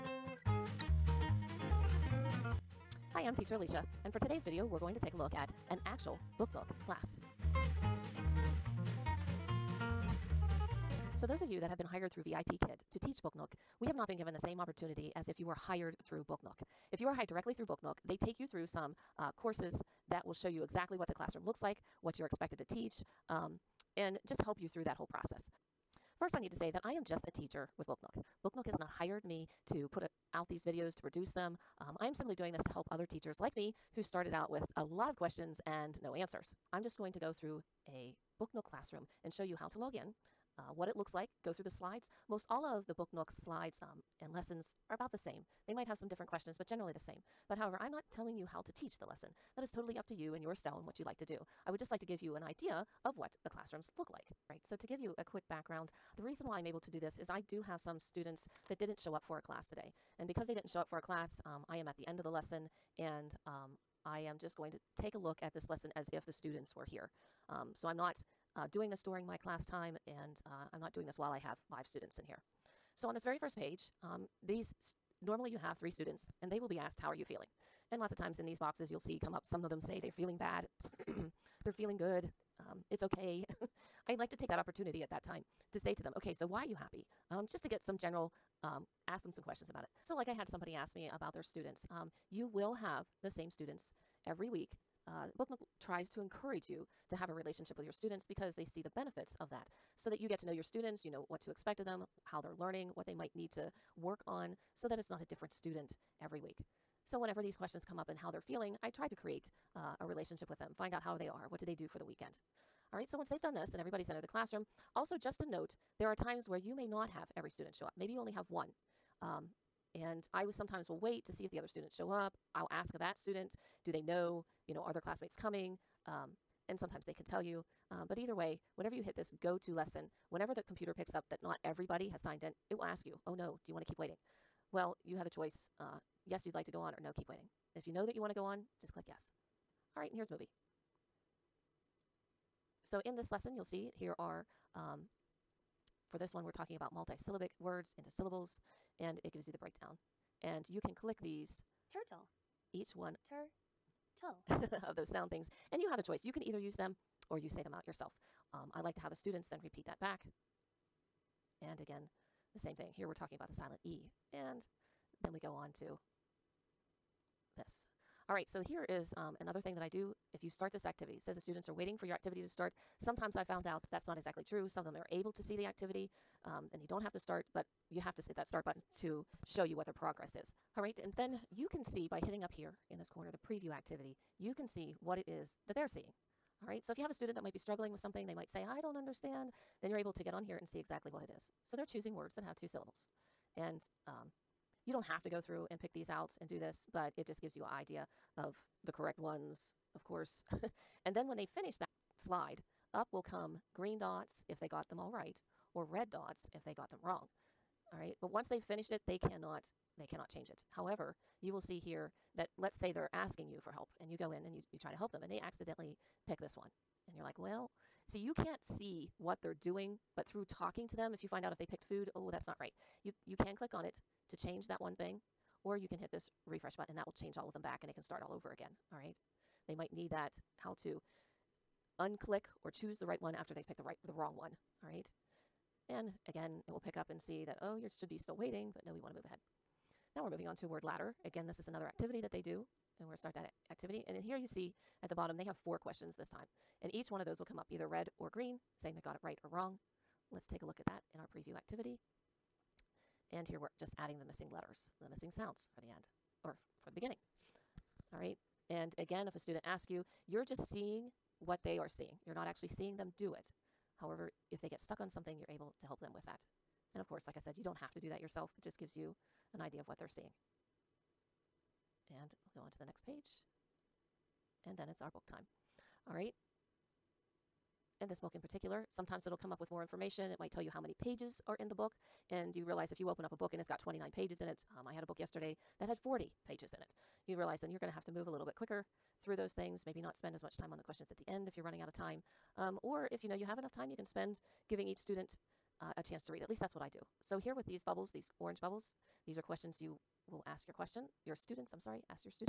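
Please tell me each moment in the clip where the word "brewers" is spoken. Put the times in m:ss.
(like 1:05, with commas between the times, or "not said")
not said.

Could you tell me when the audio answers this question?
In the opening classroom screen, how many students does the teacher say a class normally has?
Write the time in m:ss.
1:15.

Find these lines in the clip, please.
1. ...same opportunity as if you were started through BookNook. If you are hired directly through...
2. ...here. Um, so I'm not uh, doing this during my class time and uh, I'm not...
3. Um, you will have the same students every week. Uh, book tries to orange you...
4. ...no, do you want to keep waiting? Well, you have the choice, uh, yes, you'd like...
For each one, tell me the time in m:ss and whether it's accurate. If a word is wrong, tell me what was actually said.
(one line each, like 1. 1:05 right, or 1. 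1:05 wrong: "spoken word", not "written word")
1. 0:14 wrong: "hired", not "started"
2. 1:06 right
3. 1:31 wrong: "encourage", not "orange"
4. 2:13 right.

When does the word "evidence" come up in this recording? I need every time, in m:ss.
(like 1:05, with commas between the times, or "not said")
not said.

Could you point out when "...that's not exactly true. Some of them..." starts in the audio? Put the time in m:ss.
2:53.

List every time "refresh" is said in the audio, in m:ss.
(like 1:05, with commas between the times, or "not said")
3:46.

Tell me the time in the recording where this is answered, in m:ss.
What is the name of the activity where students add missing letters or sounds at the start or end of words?
4:00.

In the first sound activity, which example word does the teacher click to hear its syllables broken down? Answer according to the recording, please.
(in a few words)
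Turtle.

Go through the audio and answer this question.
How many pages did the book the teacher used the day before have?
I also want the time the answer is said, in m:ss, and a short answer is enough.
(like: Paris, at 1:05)
40, at 4:45.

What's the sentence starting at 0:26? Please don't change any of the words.
First, I need to say that I am just a teacher with BookNook.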